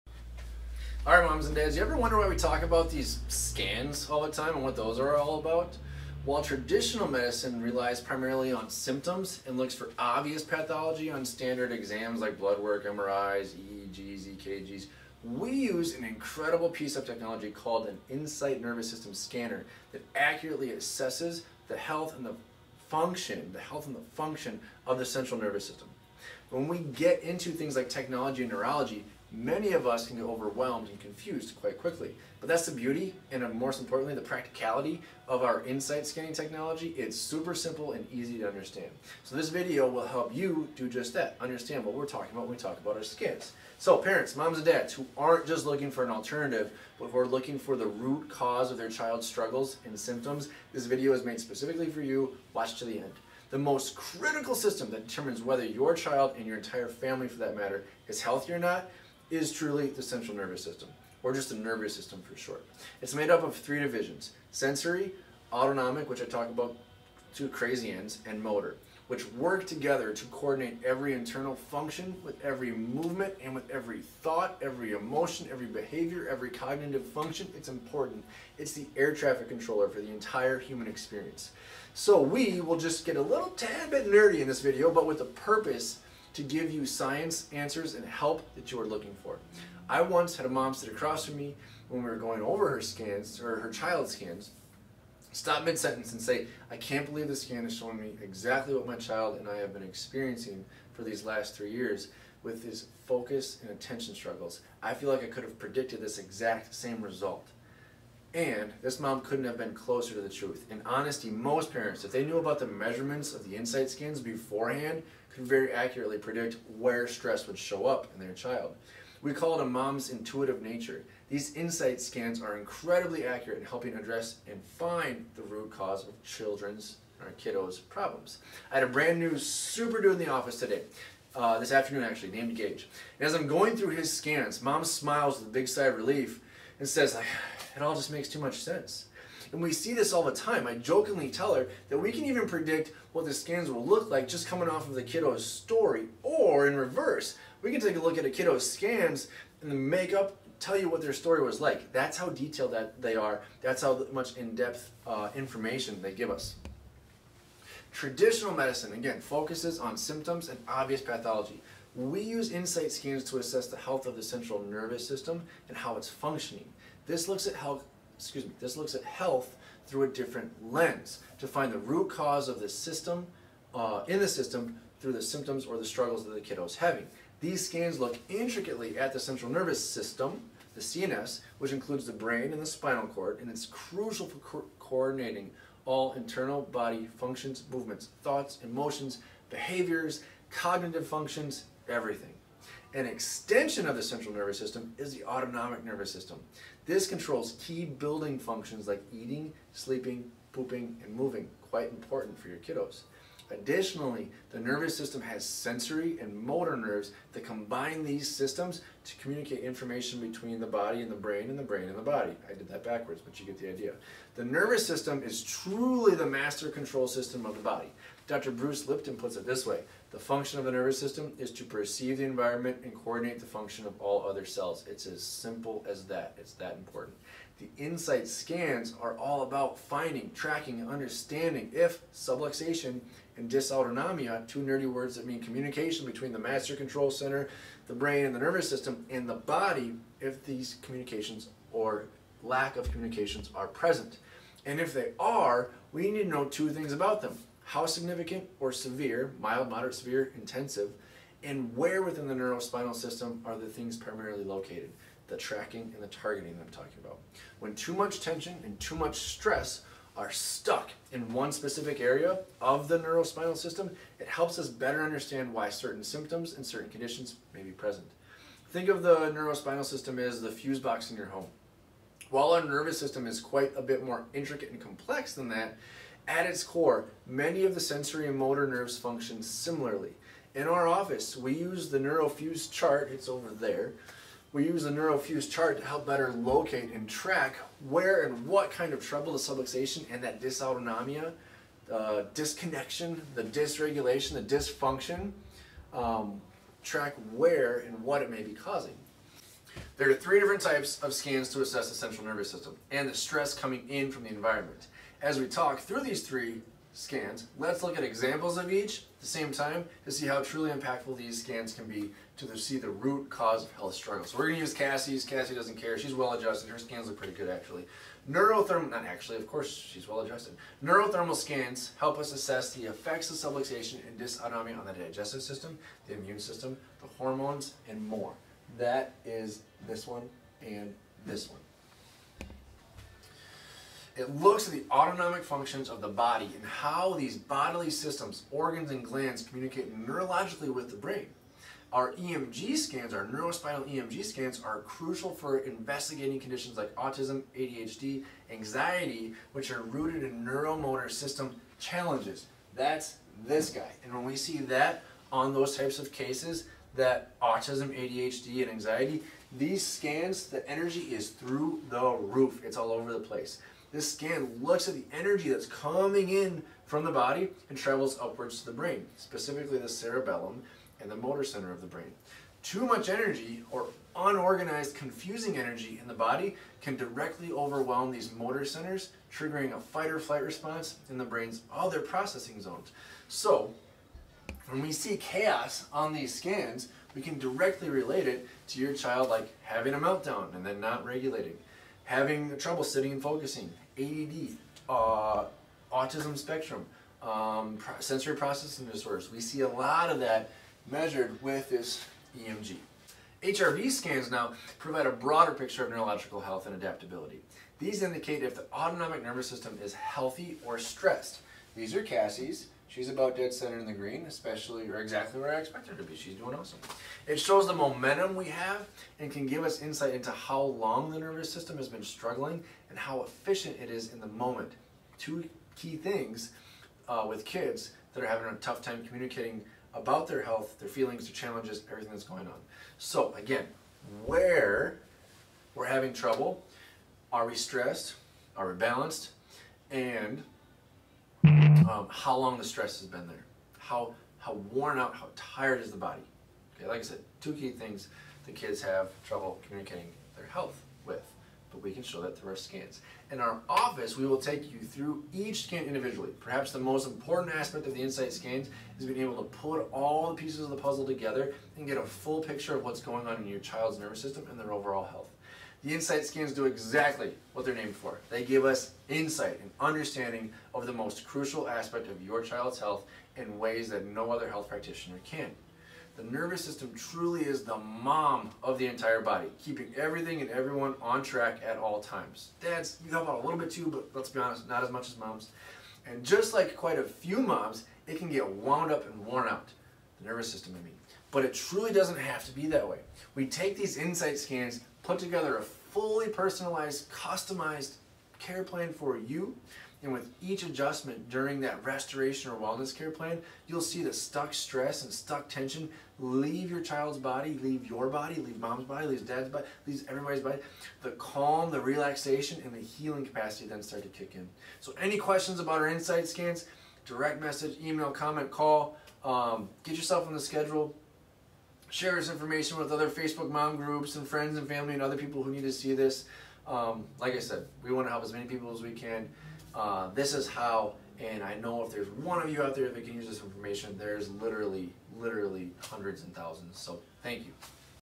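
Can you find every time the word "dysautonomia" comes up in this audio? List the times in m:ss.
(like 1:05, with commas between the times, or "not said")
3:53, 4:50, 5:24.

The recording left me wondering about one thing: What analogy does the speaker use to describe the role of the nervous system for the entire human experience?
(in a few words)
Air traffic controller.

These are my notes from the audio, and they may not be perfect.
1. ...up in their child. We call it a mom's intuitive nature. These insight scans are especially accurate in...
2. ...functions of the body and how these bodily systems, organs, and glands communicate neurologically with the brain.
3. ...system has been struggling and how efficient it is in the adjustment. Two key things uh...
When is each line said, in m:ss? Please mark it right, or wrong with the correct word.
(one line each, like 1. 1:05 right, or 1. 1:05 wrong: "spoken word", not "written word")
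1. 1:57 wrong: "incredibly", not "especially"
2. 5:35 right
3. 7:01 wrong: "moment", not "adjustment".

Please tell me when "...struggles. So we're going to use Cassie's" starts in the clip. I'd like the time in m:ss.
5:13.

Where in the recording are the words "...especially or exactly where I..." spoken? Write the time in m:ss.
6:54.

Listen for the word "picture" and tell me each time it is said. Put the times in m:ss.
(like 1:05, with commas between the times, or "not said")
6:45, 7:42.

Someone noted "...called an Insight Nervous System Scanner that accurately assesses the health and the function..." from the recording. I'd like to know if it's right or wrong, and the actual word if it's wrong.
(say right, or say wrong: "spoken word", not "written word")
right.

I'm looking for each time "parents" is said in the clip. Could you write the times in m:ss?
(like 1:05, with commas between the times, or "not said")
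0:43, 1:51.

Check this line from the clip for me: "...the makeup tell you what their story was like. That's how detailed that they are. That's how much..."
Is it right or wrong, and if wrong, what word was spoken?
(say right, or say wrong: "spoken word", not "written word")
right.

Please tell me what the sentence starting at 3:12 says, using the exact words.
An extension of the central nervous system is the autonomic nervous system.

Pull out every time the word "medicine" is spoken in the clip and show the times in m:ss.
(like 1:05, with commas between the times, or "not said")
0:07, 2:38.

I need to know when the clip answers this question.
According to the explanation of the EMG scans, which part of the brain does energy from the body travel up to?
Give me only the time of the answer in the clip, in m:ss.
6:09.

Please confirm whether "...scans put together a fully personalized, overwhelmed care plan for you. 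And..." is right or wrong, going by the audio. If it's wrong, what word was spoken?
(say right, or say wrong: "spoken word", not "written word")
wrong: "customized", not "overwhelmed".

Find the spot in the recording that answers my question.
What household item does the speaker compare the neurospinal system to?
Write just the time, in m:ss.
4:30.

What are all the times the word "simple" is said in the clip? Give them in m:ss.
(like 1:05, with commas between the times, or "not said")
0:37, 3:45.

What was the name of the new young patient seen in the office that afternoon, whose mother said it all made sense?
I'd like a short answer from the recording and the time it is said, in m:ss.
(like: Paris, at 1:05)
Gage, at 2:12.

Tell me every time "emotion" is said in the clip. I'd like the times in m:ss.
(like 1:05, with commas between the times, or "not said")
1:14, 3:08.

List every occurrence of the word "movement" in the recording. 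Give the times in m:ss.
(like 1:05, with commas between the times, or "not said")
1:12, 3:07.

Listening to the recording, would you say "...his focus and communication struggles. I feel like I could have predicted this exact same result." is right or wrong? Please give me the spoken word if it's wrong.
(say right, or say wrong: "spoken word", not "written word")
wrong: "attention", not "communication".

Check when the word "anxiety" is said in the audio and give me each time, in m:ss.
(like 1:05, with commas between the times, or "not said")
5:48, 5:58.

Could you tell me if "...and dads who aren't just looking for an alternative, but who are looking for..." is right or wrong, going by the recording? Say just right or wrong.
right.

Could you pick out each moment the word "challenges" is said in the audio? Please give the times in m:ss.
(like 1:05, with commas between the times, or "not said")
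5:51, 7:11.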